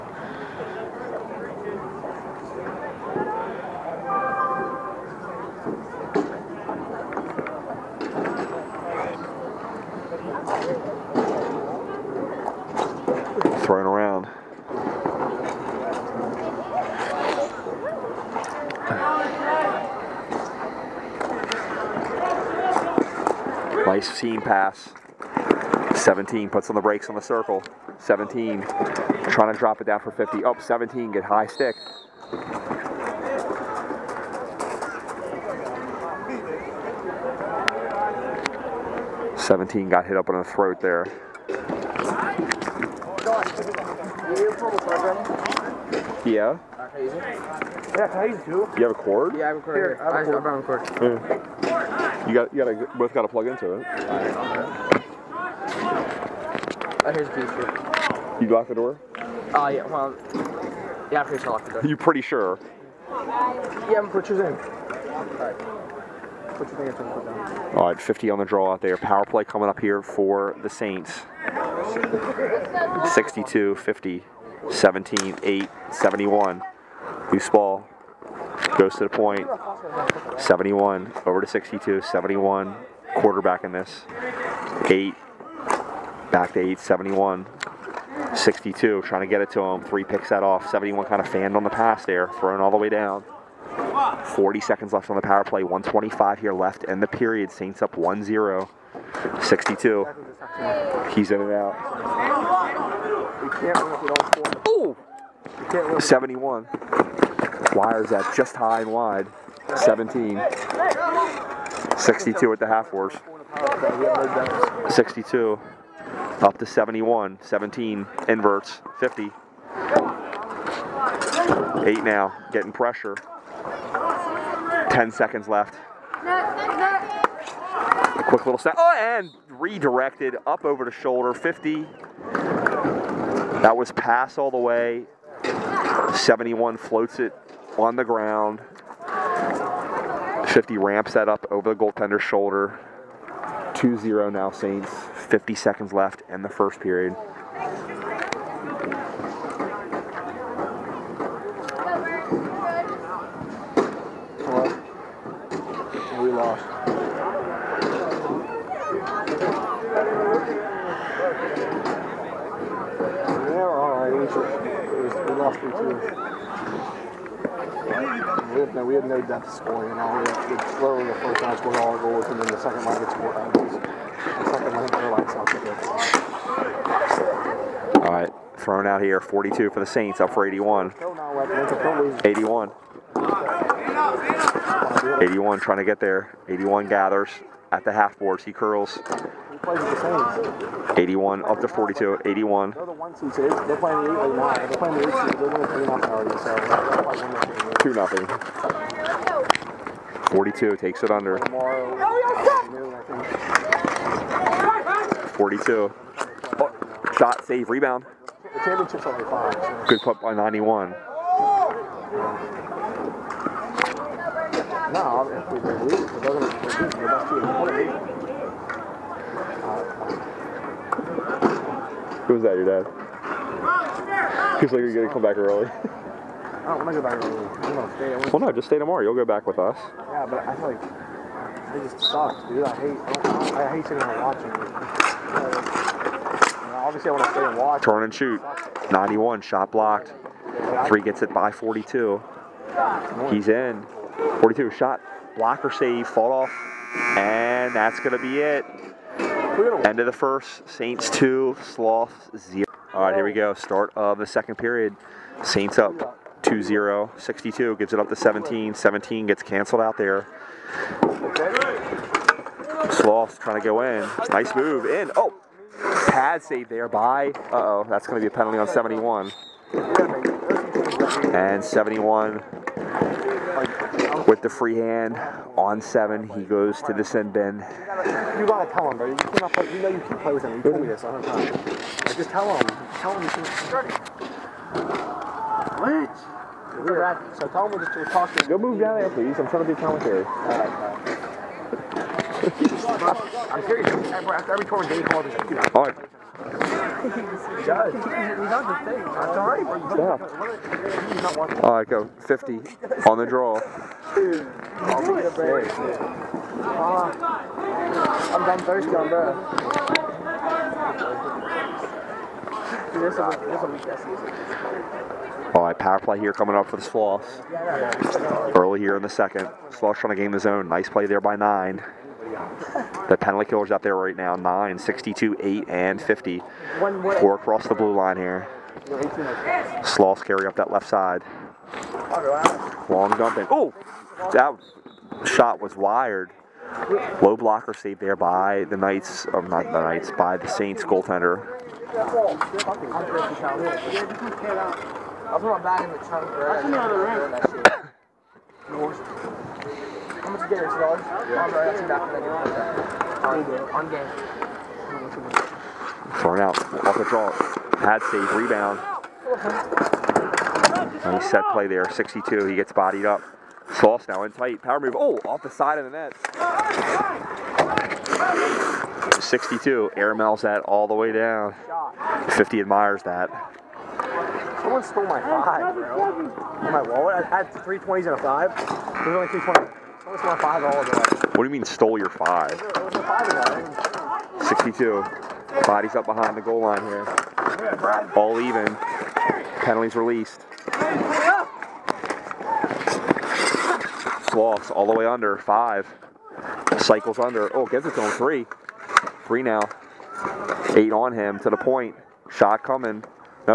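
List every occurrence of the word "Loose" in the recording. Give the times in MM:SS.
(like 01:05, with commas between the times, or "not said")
01:17.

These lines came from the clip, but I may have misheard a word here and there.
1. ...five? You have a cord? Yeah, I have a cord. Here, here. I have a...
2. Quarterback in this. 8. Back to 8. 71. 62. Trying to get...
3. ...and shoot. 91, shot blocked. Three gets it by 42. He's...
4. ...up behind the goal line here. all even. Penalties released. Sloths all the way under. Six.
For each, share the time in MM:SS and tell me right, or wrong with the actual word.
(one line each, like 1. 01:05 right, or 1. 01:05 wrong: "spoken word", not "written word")
1. 00:48 wrong: "two", not "five"
2. 01:23 right
3. 03:58 right
4. 06:25 wrong: "Five", not "Six".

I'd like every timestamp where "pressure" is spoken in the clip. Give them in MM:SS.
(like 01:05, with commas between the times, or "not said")
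02:02.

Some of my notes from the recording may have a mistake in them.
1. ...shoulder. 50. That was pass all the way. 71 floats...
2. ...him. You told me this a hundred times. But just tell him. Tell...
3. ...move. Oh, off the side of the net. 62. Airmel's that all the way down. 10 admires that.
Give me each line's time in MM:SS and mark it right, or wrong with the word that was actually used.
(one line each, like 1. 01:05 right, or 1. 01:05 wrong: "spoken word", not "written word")
1. 02:10 right
2. 04:40 right
3. 06:04 wrong: "50", not "10".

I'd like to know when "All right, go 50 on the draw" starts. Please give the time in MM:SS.
05:01.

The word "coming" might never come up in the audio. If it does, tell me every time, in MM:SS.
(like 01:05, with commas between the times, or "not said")
01:09, 05:16, 06:42.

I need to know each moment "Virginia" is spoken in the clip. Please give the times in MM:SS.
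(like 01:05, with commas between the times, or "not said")
not said.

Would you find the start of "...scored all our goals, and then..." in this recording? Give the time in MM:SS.
02:51.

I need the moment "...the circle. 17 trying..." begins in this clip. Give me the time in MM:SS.
00:27.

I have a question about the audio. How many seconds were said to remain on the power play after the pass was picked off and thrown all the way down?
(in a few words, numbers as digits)
40.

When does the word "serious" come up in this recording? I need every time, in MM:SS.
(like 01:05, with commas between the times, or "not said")
04:53.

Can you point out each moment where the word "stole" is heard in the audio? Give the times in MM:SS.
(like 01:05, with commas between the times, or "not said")
06:14, 06:21.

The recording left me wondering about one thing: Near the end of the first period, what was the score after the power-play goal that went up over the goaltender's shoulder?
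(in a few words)
2-0.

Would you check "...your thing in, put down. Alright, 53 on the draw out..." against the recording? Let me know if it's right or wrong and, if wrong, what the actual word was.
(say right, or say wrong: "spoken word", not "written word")
wrong: "50", not "53".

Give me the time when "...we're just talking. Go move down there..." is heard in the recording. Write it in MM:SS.
04:47.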